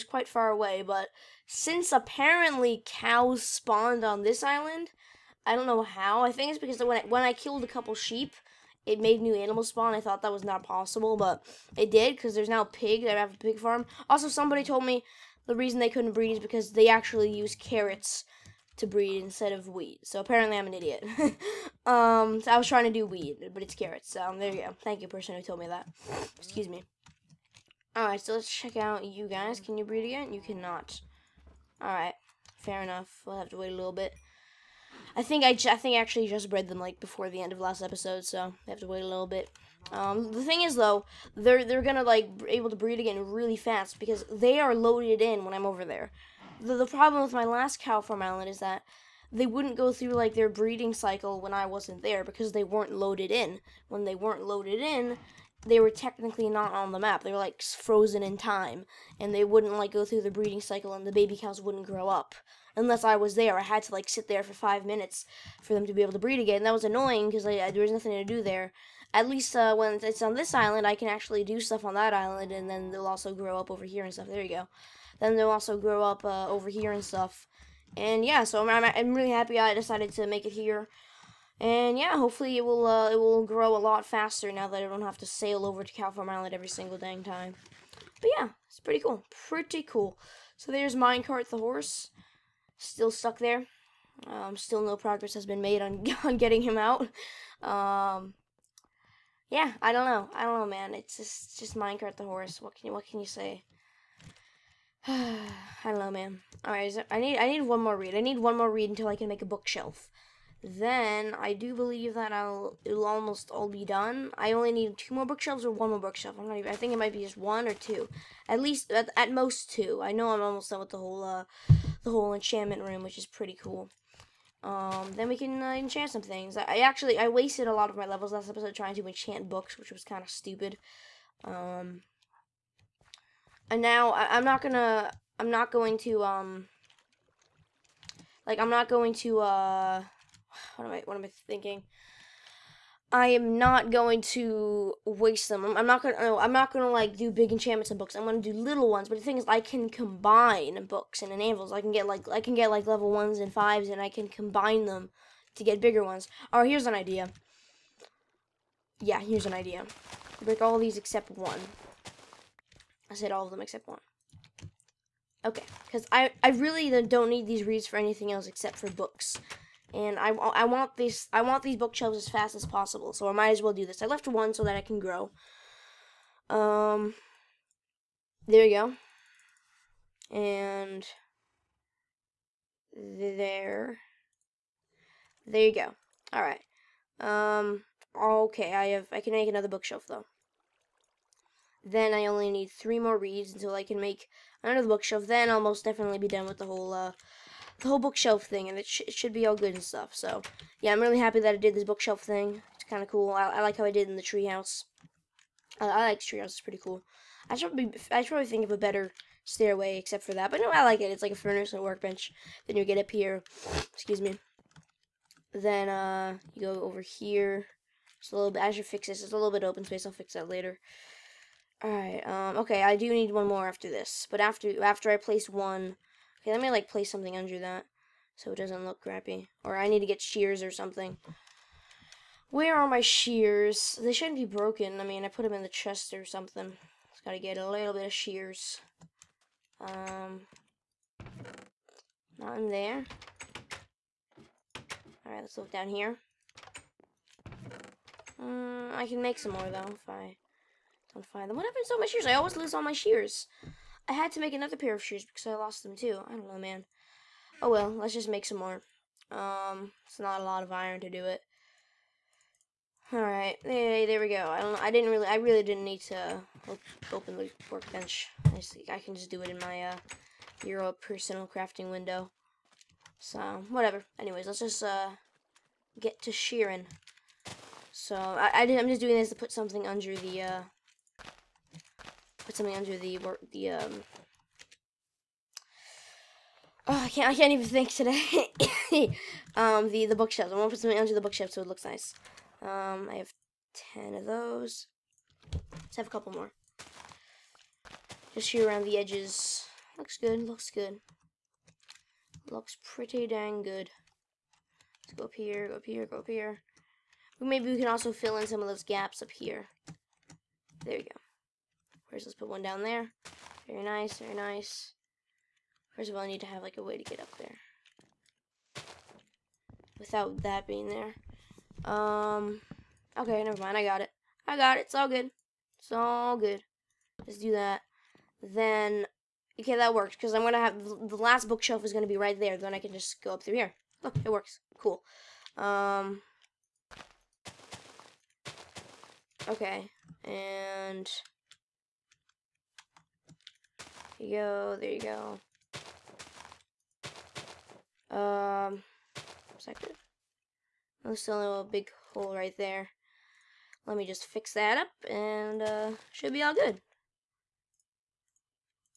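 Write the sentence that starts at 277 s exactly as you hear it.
So I, I did, I'm just doing this to put something under the uh, put something under the the um.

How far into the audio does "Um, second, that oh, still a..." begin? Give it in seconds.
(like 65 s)
348 s.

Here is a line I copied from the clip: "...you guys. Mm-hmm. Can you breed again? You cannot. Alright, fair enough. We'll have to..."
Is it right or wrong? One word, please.
right.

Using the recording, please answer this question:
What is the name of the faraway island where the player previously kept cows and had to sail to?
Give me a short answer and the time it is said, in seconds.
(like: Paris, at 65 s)
California Island, at 85 s.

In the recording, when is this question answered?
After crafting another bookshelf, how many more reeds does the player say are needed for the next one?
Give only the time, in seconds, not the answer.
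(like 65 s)
192 s.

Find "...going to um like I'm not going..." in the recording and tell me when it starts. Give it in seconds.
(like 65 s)
135 s.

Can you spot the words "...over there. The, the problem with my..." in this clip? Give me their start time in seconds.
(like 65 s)
45 s.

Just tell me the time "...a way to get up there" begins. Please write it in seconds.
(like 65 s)
316 s.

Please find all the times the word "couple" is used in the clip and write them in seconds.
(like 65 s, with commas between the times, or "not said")
7 s, 296 s.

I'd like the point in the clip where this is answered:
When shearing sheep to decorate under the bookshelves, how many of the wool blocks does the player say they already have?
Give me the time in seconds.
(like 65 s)
293 s.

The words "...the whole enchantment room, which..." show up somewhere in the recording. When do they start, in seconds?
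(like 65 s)
122 s.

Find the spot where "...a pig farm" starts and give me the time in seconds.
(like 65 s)
13 s.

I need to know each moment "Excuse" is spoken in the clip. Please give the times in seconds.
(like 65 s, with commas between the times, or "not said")
26 s, 213 s.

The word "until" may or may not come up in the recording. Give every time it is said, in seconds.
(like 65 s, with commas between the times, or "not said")
108 s, 193 s.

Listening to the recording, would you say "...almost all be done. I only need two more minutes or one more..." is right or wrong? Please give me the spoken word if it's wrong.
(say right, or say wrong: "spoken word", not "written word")
wrong: "bookshelves", not "minutes".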